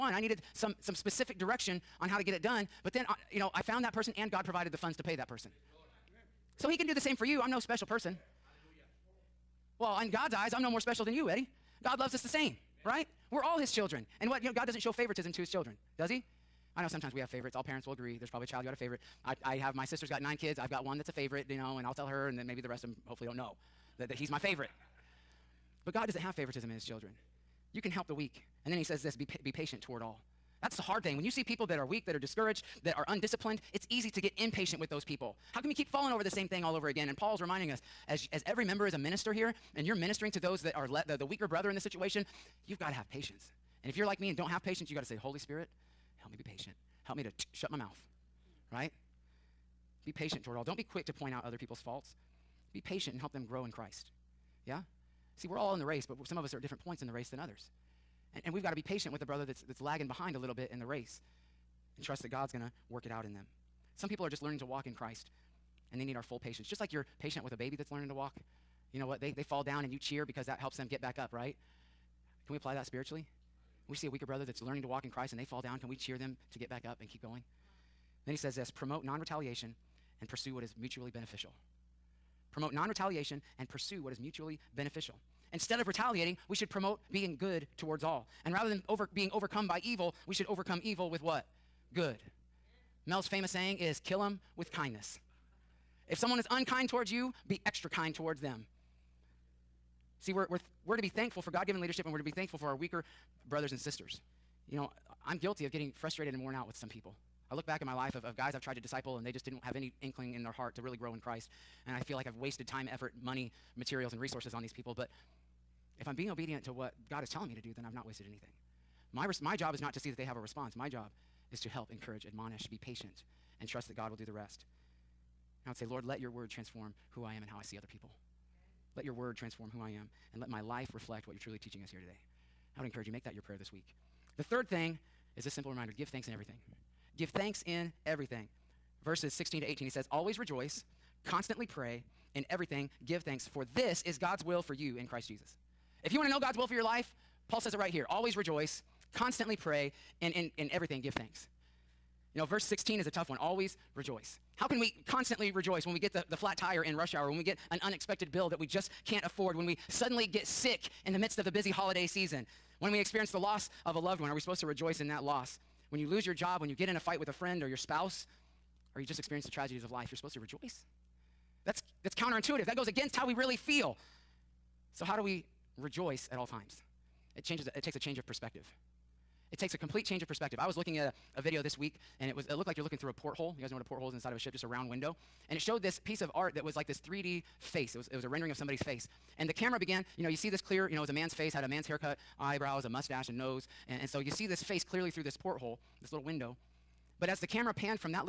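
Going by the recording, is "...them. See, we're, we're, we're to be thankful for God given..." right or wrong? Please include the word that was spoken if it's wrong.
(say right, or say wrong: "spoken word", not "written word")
right.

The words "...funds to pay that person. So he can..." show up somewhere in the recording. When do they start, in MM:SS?
00:04.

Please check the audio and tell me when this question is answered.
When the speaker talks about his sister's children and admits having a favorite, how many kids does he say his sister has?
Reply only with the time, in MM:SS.
00:20.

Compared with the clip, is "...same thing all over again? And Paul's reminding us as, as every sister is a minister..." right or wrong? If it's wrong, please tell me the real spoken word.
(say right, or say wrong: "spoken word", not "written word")
wrong: "member", not "sister".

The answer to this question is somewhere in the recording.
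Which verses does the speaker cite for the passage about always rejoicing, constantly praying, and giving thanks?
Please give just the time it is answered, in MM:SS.
02:19.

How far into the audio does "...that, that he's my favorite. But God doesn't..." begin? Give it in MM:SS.
00:23.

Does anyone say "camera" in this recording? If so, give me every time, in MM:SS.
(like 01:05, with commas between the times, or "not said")
03:09, 03:17.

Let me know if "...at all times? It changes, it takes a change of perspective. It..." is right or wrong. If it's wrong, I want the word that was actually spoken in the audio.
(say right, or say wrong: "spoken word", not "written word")
right.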